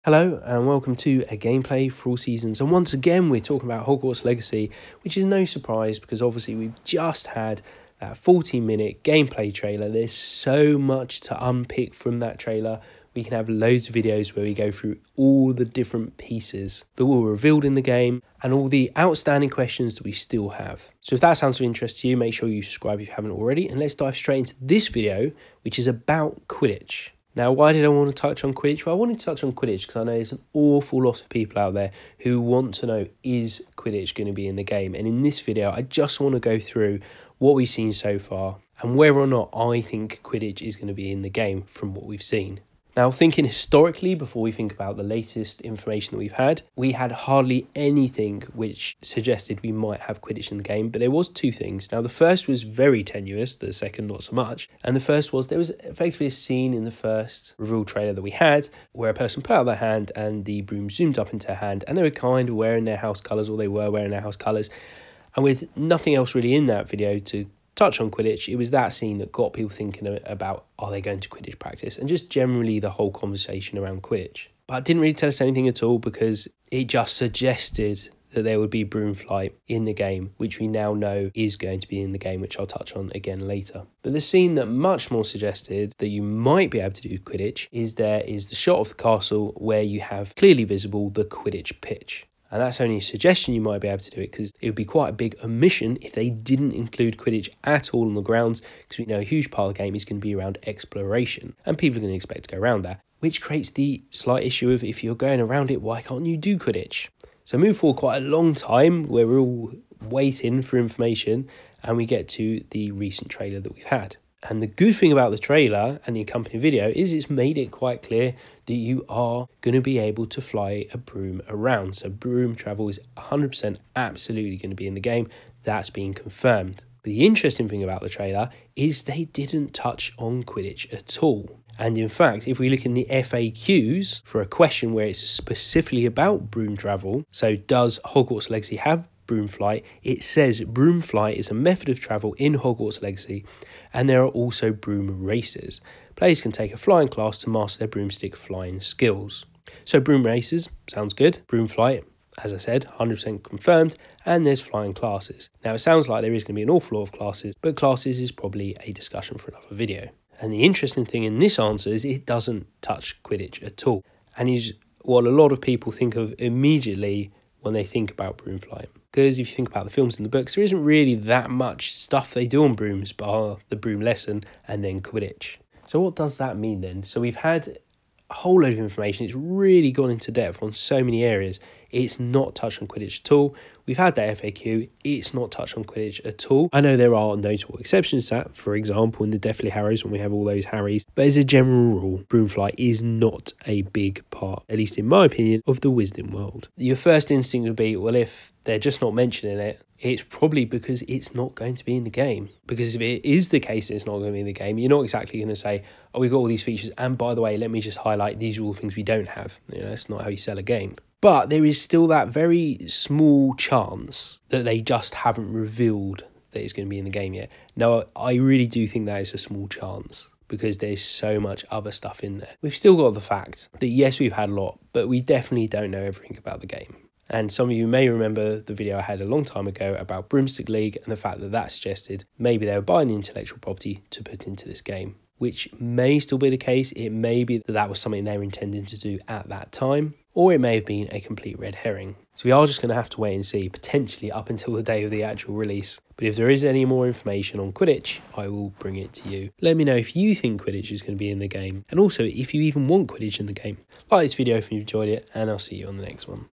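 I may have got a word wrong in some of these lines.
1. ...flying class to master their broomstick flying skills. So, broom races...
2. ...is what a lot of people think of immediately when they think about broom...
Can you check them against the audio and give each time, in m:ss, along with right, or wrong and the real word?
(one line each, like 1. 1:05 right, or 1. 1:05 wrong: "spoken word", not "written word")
1. 2:26 right
2. 2:44 right.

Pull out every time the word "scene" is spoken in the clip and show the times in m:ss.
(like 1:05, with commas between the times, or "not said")
0:56, 1:08, 1:24.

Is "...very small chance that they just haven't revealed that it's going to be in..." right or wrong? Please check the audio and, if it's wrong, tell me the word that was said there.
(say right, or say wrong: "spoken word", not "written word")
right.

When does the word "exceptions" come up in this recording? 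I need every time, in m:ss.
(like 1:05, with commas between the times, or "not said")
3:07.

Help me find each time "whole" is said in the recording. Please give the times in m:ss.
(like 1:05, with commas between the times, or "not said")
1:12, 2:58.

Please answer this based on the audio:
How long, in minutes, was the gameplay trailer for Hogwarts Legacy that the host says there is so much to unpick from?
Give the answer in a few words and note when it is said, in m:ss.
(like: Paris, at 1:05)
40 minutes, at 0:08.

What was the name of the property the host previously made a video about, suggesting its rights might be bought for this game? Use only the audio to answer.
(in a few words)
Broomstick League.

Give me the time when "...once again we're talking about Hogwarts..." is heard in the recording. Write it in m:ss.
0:02.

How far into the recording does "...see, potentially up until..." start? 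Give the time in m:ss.
4:03.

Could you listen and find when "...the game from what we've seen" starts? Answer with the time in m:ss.
0:41.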